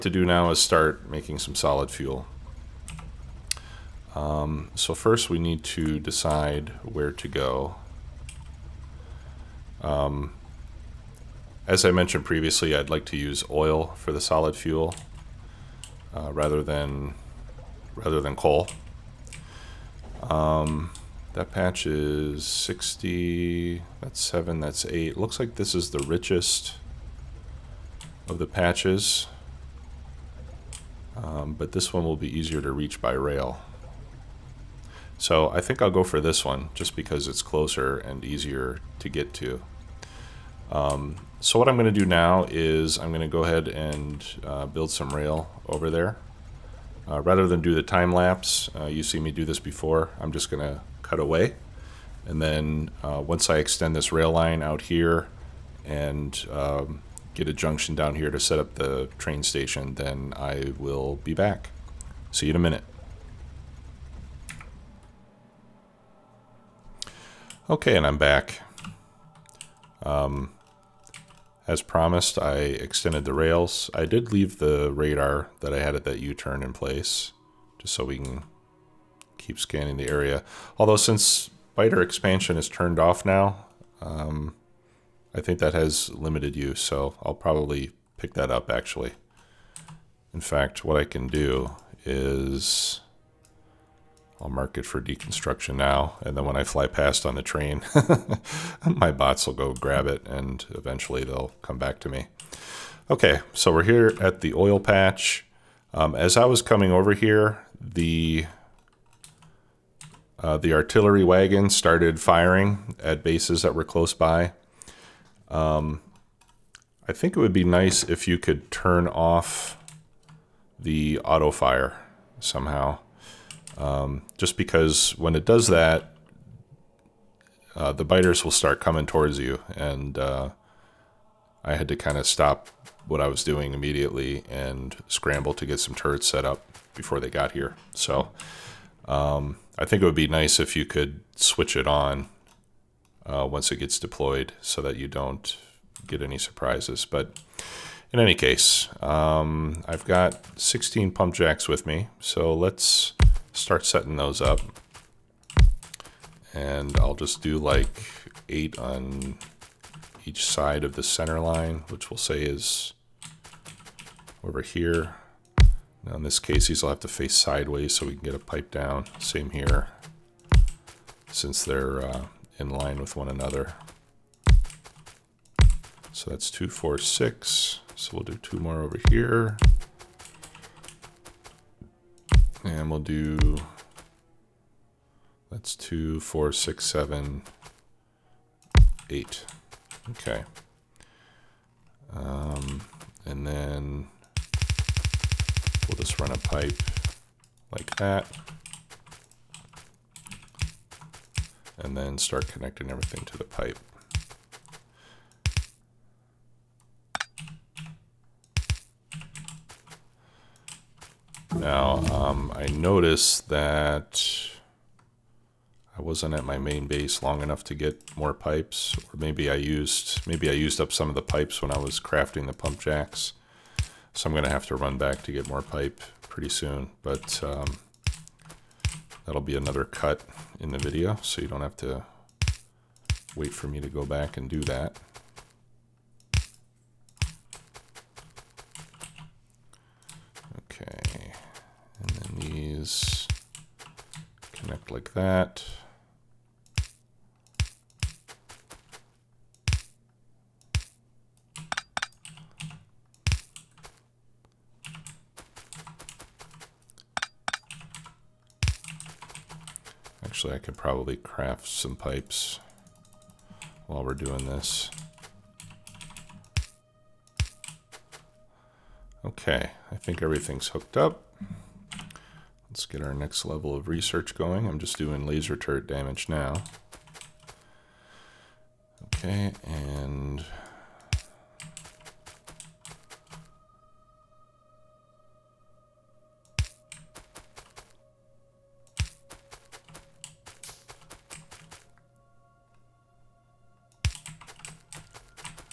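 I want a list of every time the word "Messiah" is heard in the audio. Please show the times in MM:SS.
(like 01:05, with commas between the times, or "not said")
not said.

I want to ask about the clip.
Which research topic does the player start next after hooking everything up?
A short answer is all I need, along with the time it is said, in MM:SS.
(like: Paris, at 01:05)
laser turret damage, at 04:35.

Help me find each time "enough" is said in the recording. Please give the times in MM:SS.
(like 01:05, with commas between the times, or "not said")
03:37.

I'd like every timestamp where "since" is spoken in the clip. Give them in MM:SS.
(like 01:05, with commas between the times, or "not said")
01:20, 02:51.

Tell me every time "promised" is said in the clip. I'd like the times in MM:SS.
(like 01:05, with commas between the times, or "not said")
01:11.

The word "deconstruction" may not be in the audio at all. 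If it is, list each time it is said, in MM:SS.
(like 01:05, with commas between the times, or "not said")
01:35.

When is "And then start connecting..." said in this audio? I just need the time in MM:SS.
03:21.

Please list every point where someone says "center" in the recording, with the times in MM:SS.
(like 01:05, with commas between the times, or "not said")
02:41.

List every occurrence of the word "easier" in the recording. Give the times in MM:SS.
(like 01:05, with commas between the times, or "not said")
00:32, 00:38.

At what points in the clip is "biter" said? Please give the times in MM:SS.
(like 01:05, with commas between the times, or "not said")
01:21, 02:08.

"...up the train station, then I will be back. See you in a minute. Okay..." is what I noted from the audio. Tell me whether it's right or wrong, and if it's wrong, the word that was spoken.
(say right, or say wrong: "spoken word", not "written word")
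right.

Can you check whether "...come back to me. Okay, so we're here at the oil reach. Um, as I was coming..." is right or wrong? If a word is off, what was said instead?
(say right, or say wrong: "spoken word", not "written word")
wrong: "patch", not "reach".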